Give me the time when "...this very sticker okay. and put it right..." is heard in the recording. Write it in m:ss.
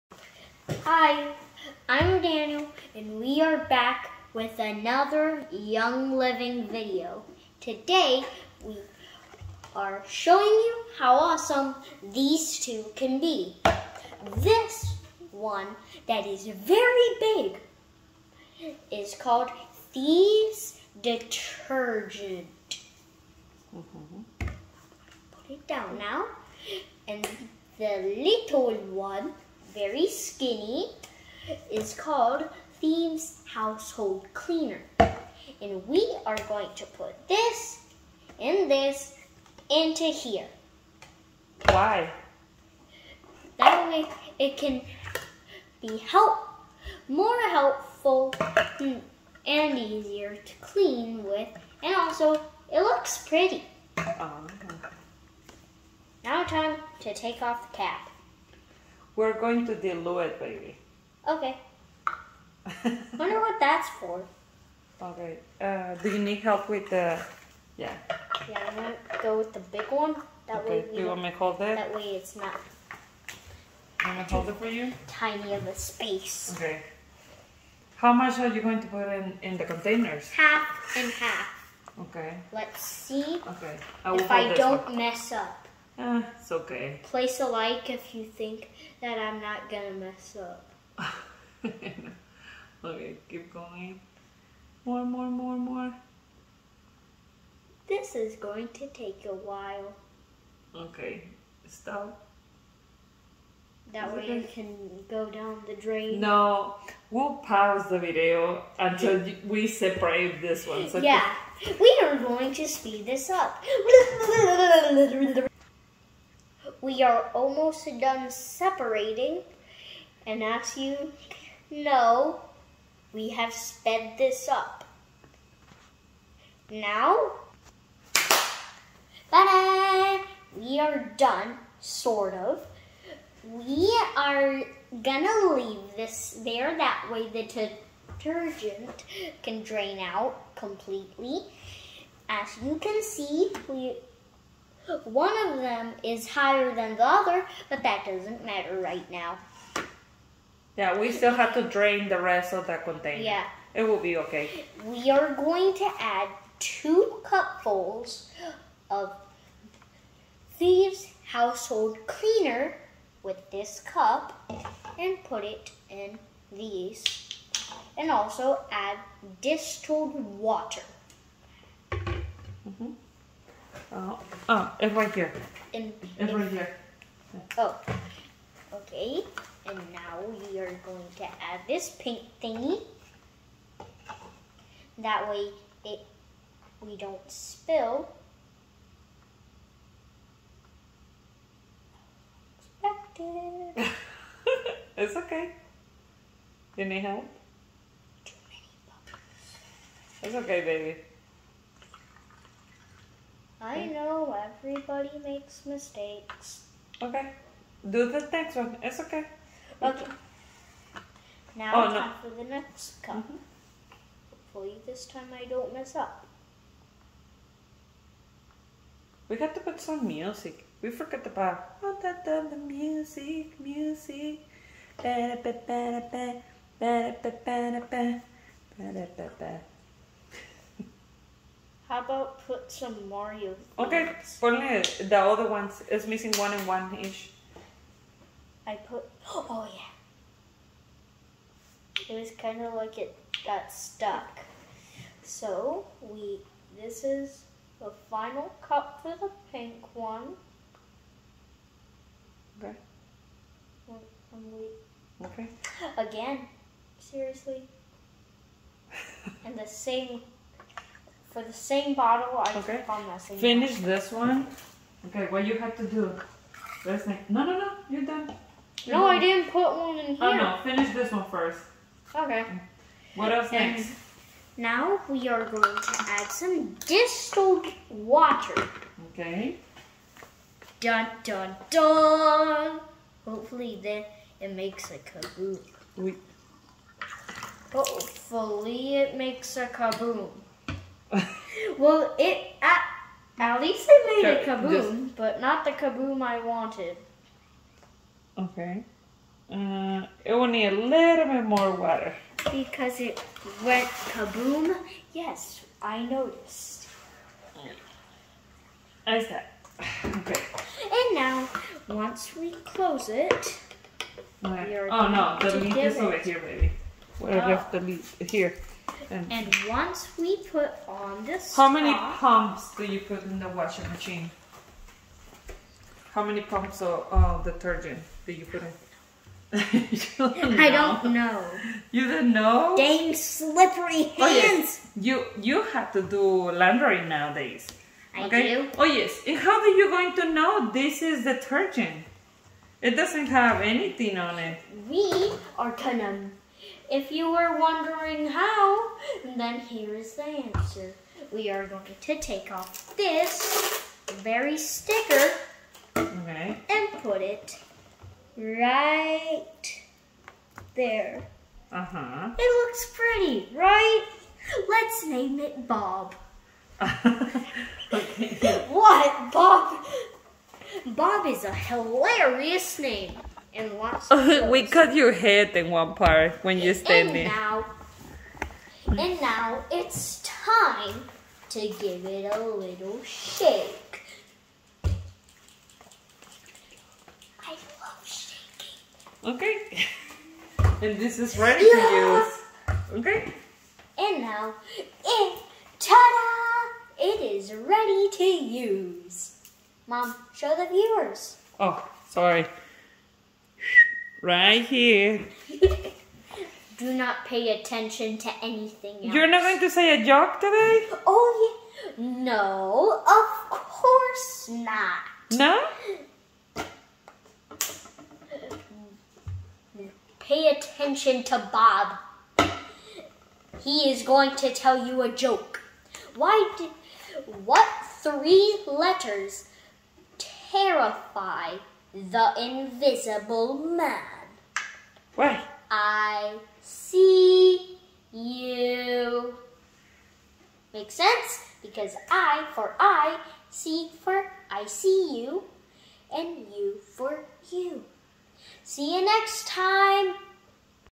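5:52.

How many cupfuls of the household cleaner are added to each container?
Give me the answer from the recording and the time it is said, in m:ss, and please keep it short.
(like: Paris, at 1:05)
2, at 2:36.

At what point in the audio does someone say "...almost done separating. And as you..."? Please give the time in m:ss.
1:57.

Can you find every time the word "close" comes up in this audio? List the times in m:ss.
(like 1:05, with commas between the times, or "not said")
5:12.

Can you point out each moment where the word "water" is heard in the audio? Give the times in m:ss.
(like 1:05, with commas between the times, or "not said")
2:50, 4:37, 5:01.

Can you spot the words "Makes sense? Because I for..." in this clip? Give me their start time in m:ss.
7:20.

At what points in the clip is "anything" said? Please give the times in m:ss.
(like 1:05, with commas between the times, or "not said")
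5:43, 6:48.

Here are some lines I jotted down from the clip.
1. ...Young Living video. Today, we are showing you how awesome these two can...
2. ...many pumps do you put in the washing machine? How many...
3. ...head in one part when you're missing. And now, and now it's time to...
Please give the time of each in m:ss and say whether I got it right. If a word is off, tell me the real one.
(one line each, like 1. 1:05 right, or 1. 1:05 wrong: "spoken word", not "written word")
1. 0:05 right
2. 5:21 right
3. 6:15 wrong: "standing", not "missing".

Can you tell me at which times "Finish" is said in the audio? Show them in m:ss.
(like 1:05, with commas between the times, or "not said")
4:23, 4:30.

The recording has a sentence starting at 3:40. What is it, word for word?
We forgot about oh, da, da, the music, music.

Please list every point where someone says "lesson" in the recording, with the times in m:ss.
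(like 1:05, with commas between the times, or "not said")
not said.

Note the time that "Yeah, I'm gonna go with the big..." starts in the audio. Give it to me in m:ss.
1:08.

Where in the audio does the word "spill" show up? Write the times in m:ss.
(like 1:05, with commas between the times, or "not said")
3:07.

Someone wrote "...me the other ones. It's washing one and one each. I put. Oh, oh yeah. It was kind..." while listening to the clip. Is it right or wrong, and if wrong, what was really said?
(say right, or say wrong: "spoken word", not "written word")
wrong: "missing", not "washing".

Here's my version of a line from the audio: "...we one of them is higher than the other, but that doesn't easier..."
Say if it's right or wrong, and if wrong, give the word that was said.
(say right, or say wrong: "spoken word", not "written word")
wrong: "matter", not "easier".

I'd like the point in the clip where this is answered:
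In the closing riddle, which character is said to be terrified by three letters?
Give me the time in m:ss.
7:11.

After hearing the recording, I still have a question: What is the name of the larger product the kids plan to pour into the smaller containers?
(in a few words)
Thieves Detergent.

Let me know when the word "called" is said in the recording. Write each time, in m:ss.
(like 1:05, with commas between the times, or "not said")
0:19, 0:31.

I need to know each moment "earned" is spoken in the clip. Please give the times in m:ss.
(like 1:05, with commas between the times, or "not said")
not said.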